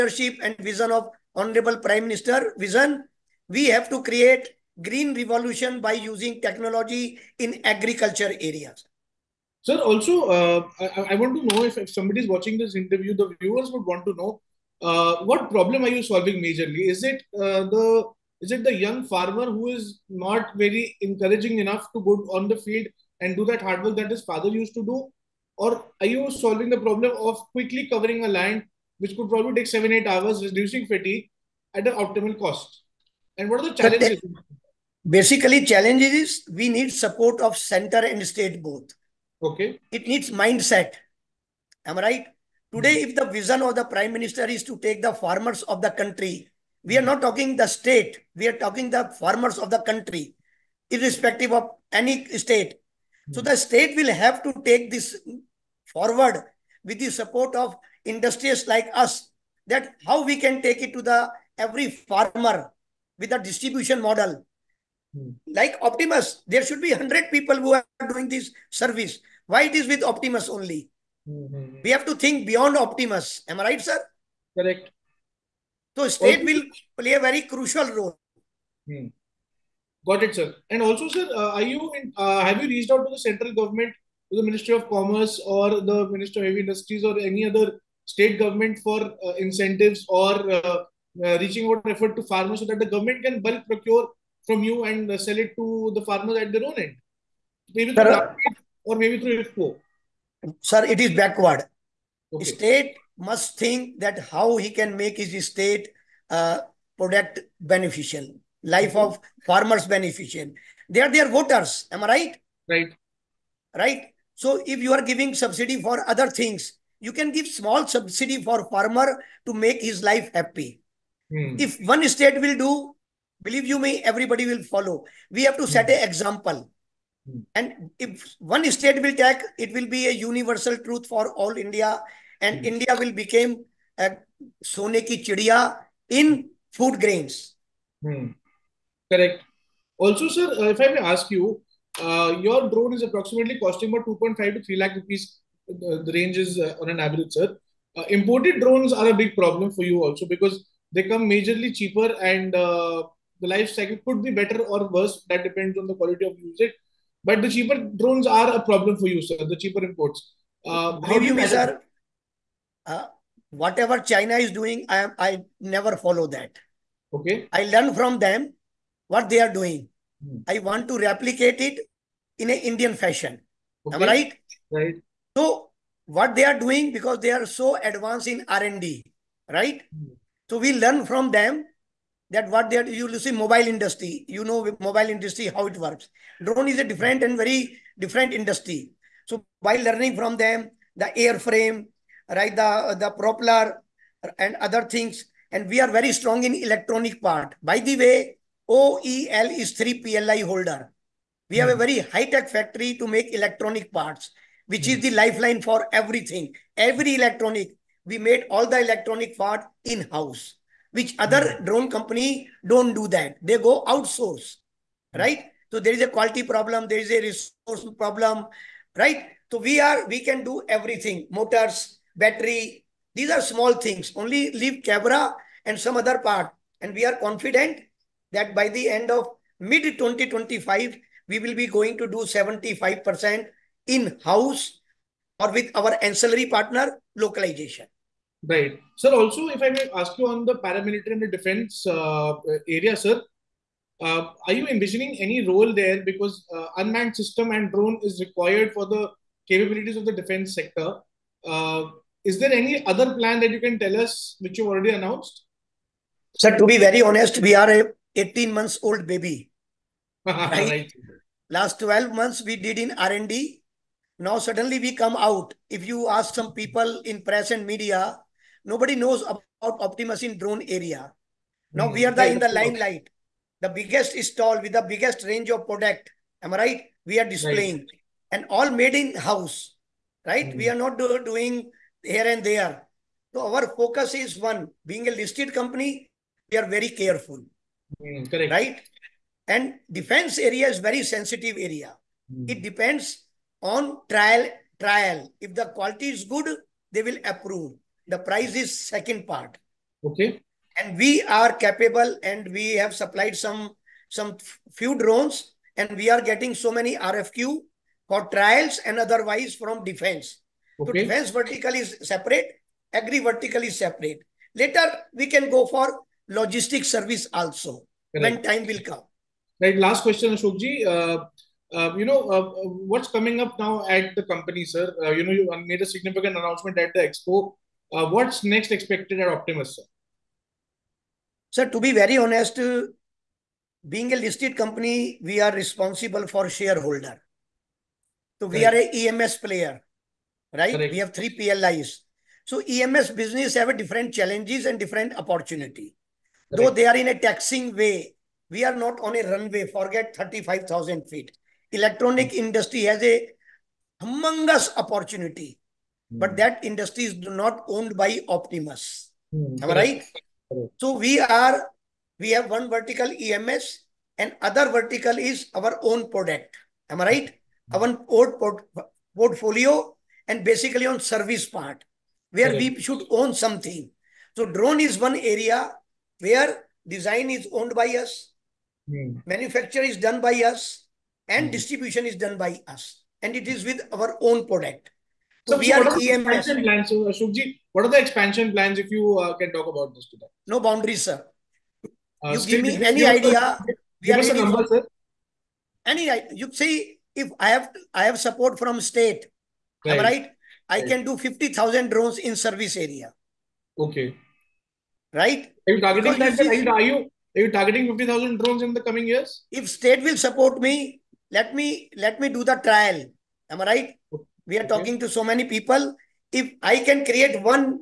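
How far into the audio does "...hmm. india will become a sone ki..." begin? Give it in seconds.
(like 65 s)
132 s.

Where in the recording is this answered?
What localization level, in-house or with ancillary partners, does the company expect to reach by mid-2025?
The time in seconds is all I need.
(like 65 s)
232 s.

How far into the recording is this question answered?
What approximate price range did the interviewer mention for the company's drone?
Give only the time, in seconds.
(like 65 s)
144 s.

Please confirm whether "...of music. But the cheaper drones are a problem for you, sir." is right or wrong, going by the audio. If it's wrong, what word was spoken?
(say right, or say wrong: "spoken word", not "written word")
right.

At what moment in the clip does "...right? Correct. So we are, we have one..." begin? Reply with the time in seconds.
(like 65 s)
359 s.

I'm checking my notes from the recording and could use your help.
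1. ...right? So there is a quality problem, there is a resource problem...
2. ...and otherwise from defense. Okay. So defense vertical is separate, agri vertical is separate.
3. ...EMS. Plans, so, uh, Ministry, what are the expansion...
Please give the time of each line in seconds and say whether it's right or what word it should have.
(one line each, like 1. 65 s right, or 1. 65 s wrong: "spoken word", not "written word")
1. 215 s right
2. 308 s right
3. 385 s wrong: "Shukji", not "Ministry".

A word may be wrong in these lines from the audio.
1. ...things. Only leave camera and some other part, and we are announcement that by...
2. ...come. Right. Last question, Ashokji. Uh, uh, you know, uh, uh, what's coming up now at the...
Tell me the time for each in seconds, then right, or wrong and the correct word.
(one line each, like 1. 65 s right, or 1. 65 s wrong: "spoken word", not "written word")
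1. 223 s wrong: "confident", not "announcement"
2. 318 s right.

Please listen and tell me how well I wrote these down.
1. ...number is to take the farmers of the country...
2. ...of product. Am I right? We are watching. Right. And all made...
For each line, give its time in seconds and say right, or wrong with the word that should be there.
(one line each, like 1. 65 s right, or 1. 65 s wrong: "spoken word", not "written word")
1. 44 s wrong: "minister", not "number"
2. 275 s wrong: "displaying", not "watching".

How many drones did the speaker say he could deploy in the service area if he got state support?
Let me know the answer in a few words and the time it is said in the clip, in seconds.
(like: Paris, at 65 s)
50,000, at 401 s.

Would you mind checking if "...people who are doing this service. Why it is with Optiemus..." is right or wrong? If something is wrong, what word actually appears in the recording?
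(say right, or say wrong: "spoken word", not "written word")
right.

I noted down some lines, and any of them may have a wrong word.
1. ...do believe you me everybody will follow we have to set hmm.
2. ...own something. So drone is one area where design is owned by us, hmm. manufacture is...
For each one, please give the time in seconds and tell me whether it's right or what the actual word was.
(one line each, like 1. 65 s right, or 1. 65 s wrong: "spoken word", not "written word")
1. 122 s right
2. 373 s right.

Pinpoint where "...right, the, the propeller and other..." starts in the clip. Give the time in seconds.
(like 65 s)
192 s.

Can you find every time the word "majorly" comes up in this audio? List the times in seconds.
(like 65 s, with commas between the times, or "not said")
16 s, 151 s.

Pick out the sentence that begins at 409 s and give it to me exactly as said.
If state will support me, let me let me do the trial.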